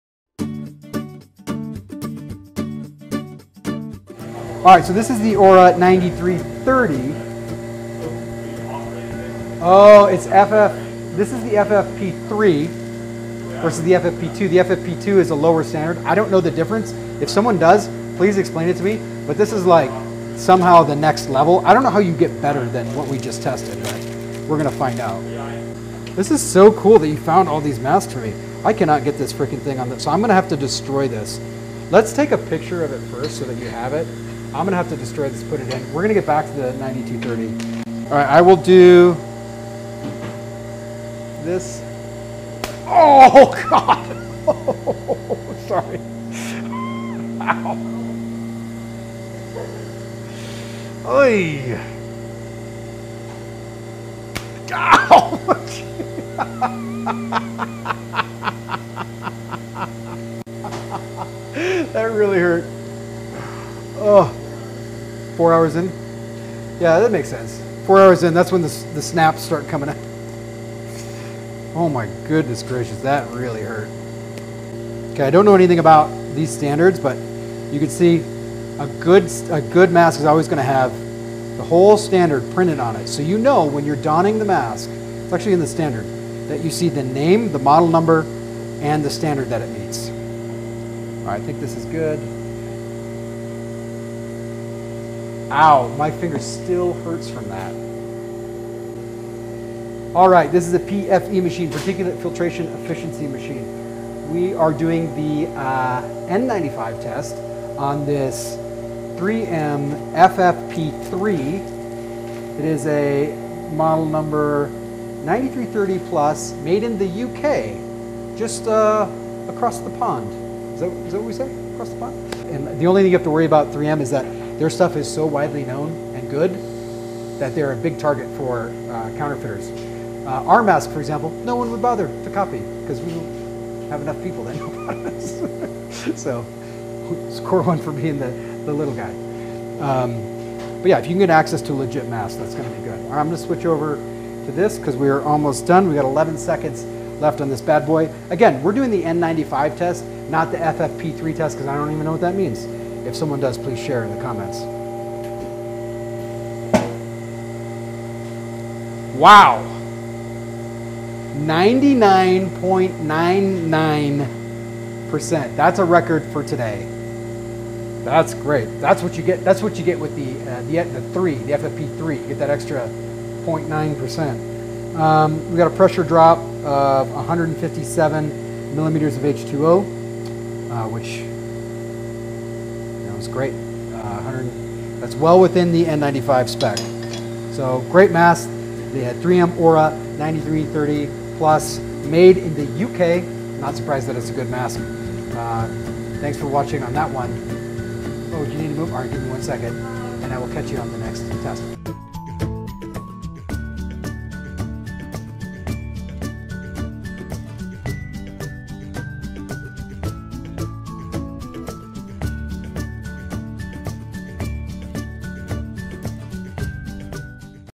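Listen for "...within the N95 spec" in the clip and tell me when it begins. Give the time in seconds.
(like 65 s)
185 s.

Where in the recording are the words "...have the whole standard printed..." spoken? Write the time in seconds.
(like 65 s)
80 s.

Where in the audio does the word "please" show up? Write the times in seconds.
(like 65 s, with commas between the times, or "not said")
18 s, 153 s.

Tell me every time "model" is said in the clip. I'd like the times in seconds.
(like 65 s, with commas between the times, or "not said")
87 s, 113 s.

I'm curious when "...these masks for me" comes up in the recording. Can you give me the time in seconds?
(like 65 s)
27 s.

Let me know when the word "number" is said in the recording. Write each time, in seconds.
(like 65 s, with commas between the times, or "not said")
87 s, 114 s.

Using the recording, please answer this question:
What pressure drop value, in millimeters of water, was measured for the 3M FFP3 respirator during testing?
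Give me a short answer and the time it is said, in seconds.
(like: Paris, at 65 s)
157, at 177 s.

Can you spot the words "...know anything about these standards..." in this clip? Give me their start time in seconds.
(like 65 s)
75 s.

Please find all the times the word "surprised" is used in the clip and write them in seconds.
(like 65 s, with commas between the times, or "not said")
193 s.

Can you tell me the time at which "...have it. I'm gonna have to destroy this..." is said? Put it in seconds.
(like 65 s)
33 s.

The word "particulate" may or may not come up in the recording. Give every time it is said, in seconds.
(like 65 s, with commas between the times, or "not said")
101 s.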